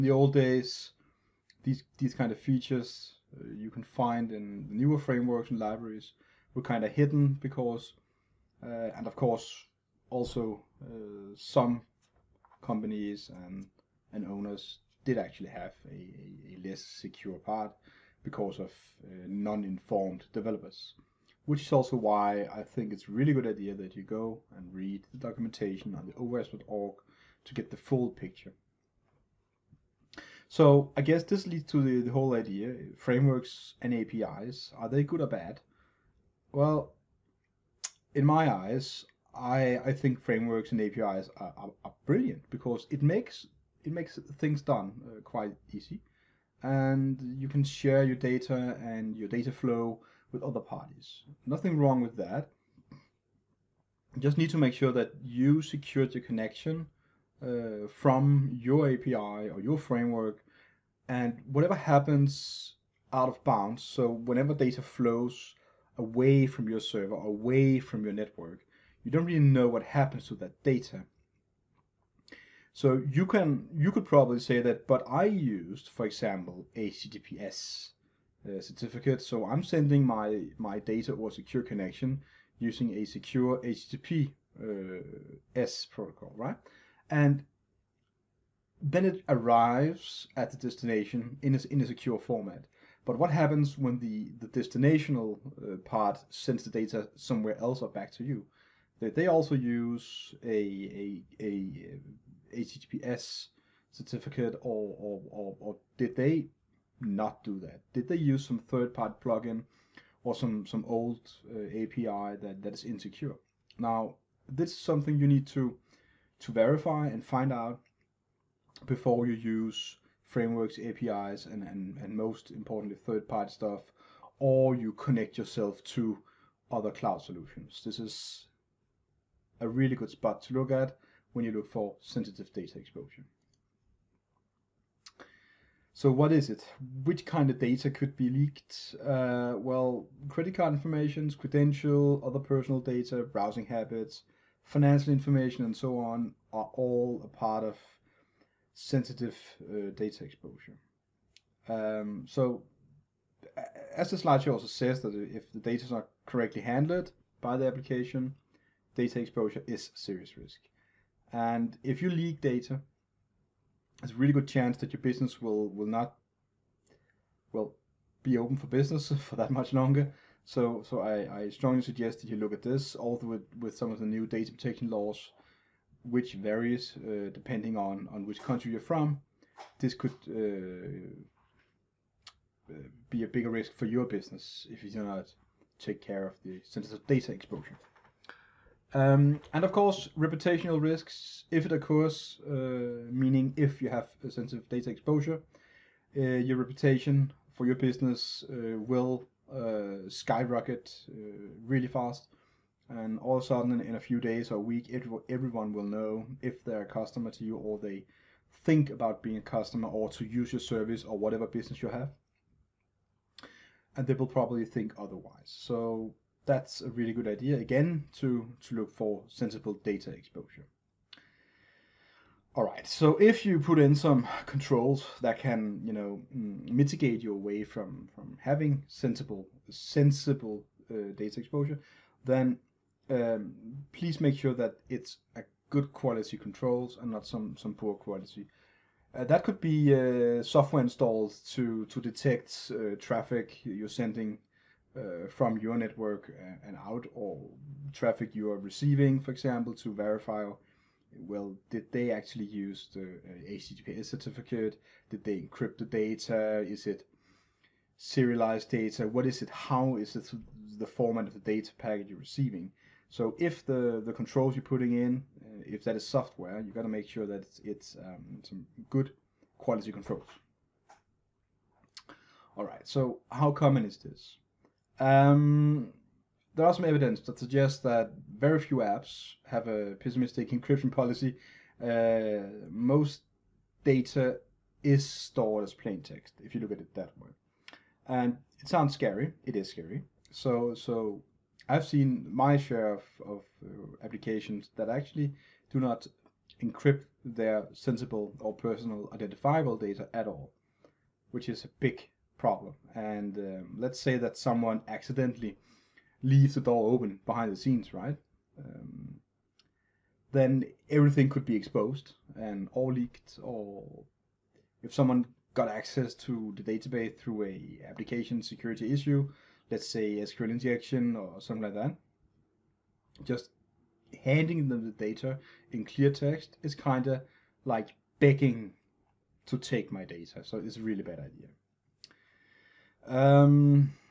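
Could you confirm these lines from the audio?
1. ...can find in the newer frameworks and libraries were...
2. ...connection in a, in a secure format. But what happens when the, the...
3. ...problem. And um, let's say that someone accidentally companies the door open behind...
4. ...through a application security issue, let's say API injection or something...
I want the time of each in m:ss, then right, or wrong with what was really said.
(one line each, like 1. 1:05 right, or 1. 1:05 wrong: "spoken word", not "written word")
1. 0:03 right
2. 1:30 wrong: "destination", not "connection"
3. 5:02 wrong: "leaves", not "companies"
4. 5:17 wrong: "SQL", not "API".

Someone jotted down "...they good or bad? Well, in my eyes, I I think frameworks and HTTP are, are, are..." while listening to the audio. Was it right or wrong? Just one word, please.
wrong.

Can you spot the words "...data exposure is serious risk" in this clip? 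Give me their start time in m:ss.
2:38.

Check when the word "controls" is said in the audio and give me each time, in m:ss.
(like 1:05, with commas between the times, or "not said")
3:44, 3:56, 4:24, 4:29.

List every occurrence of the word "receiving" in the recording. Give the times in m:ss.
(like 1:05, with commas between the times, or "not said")
4:08, 4:22.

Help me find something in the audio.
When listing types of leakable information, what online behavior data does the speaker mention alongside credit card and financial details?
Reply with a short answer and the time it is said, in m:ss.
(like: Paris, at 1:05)
browsing habits, at 2:23.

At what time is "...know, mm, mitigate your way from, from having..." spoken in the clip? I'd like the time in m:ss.
3:45.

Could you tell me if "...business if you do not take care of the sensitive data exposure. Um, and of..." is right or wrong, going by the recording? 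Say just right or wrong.
right.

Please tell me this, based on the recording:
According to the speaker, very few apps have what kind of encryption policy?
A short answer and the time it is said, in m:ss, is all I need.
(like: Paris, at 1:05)
pessimistic, at 4:39.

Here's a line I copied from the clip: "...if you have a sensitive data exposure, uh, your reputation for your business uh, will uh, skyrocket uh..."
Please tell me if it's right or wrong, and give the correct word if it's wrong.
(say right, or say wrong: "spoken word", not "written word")
right.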